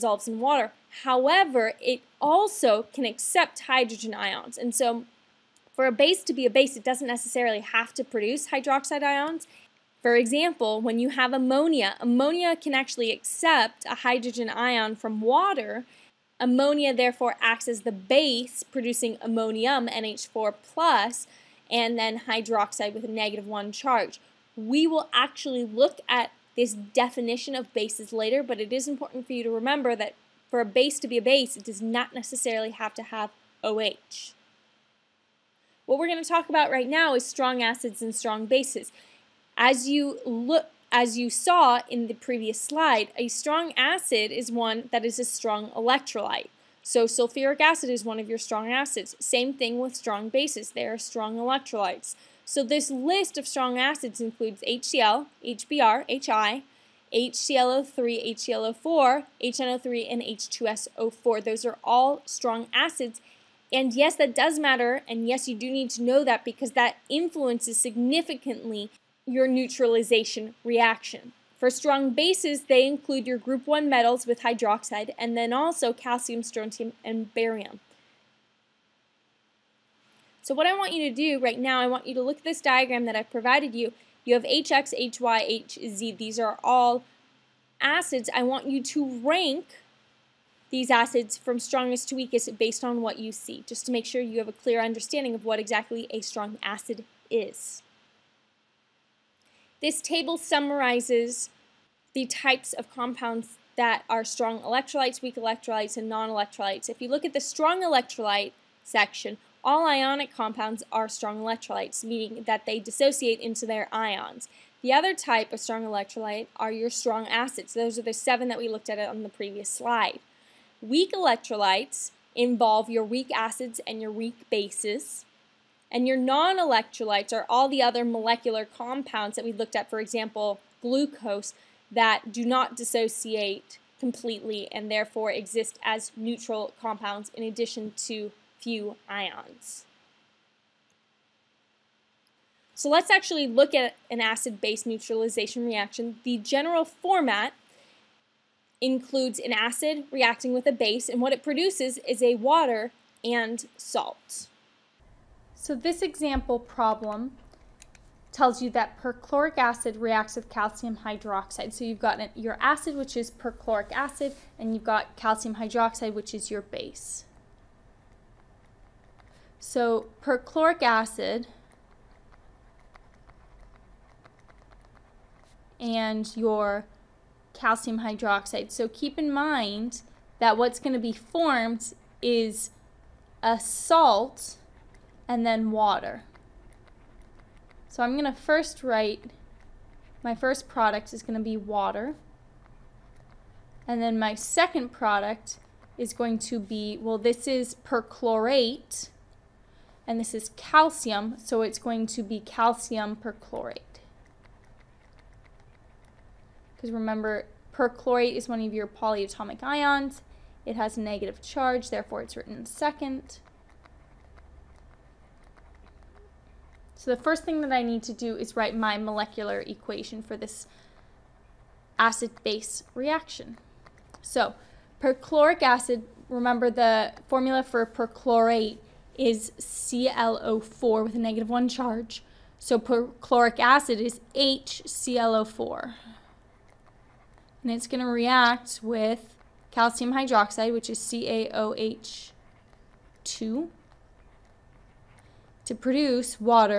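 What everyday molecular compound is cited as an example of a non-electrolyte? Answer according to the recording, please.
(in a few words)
glucose.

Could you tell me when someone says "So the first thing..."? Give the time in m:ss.
3:36.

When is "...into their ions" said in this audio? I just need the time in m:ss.
1:53.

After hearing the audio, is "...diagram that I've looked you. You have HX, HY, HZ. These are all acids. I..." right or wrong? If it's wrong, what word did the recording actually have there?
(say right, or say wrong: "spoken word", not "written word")
wrong: "provided", not "looked".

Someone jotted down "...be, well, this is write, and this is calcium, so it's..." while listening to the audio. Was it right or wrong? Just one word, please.
wrong.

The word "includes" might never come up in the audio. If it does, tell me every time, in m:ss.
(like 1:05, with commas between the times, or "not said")
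0:54, 1:12, 2:28.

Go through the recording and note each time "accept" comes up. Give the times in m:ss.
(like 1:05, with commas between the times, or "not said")
0:03, 0:13.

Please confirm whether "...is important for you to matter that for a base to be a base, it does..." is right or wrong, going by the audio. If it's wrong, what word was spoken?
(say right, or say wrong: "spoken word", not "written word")
wrong: "remember", not "matter".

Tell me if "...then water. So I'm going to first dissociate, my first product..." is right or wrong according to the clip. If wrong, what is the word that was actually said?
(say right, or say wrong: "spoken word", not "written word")
wrong: "write", not "dissociate".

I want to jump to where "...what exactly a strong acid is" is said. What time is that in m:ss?
1:35.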